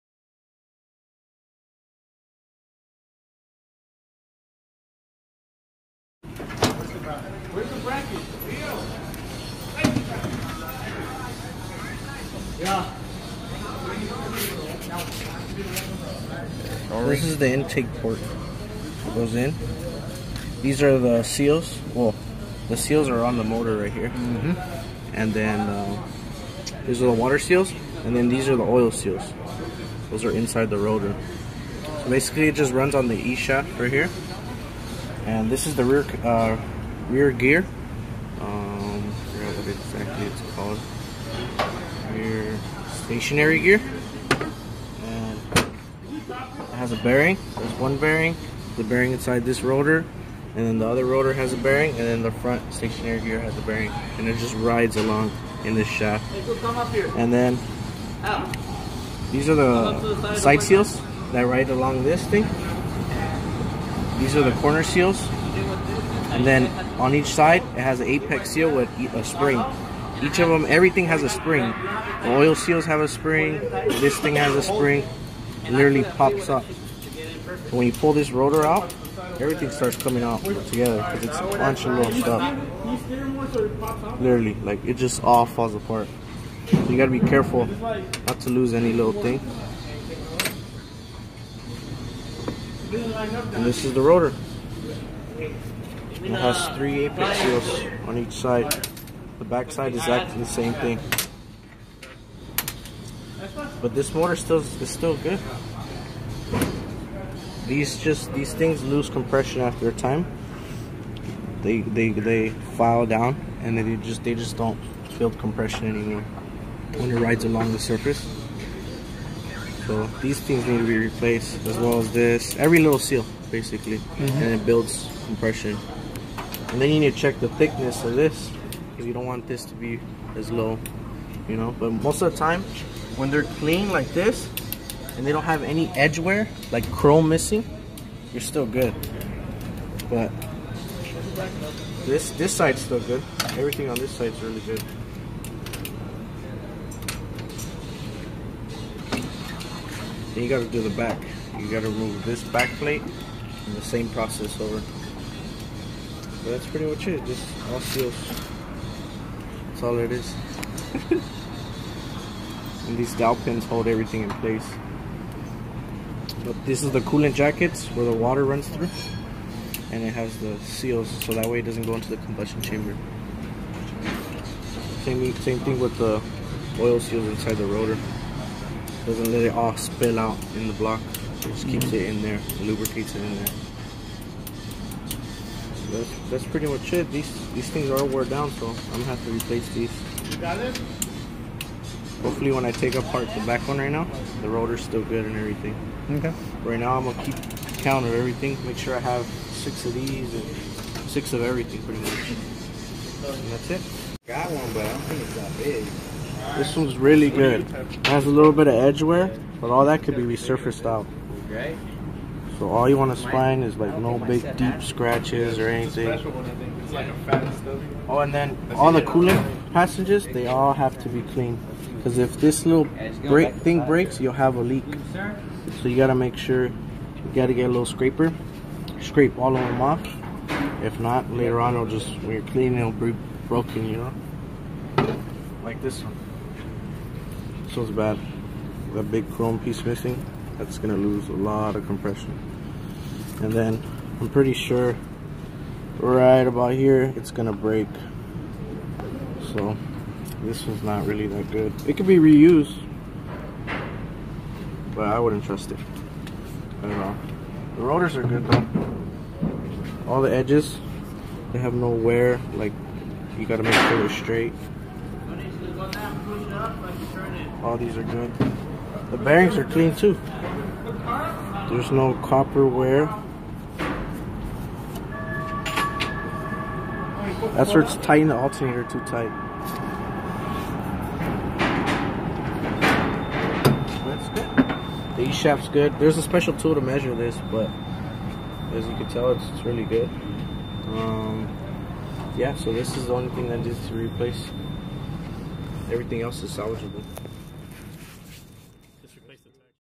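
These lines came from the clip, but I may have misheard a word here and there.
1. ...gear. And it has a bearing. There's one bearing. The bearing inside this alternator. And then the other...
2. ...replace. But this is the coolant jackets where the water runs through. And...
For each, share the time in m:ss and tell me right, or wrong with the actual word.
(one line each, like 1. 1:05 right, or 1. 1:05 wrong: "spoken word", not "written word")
1. 0:43 wrong: "rotor", not "alternator"
2. 2:44 wrong: "place", not "replace".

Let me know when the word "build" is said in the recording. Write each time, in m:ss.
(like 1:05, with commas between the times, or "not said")
1:55, 2:04.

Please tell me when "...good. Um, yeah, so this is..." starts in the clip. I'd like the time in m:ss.
4:49.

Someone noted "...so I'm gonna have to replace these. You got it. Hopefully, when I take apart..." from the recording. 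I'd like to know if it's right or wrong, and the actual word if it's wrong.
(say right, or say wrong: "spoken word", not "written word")
right.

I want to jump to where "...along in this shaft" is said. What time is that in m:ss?
0:54.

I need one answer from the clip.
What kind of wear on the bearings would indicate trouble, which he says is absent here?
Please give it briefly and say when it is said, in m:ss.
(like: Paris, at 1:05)
Copper wear, at 4:32.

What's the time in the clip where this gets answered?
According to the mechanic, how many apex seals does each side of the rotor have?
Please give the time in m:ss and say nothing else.
1:36.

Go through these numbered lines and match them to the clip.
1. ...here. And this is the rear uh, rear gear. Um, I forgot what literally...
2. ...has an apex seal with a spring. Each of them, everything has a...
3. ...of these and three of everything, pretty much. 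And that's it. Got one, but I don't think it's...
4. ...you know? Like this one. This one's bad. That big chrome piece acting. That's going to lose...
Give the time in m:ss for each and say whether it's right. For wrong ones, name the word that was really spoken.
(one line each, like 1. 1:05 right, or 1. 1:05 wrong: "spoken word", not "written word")
1. 0:33 wrong: "exactly", not "literally"
2. 1:07 right
3. 3:19 wrong: "six", not "three"
4. 3:53 wrong: "missing", not "acting".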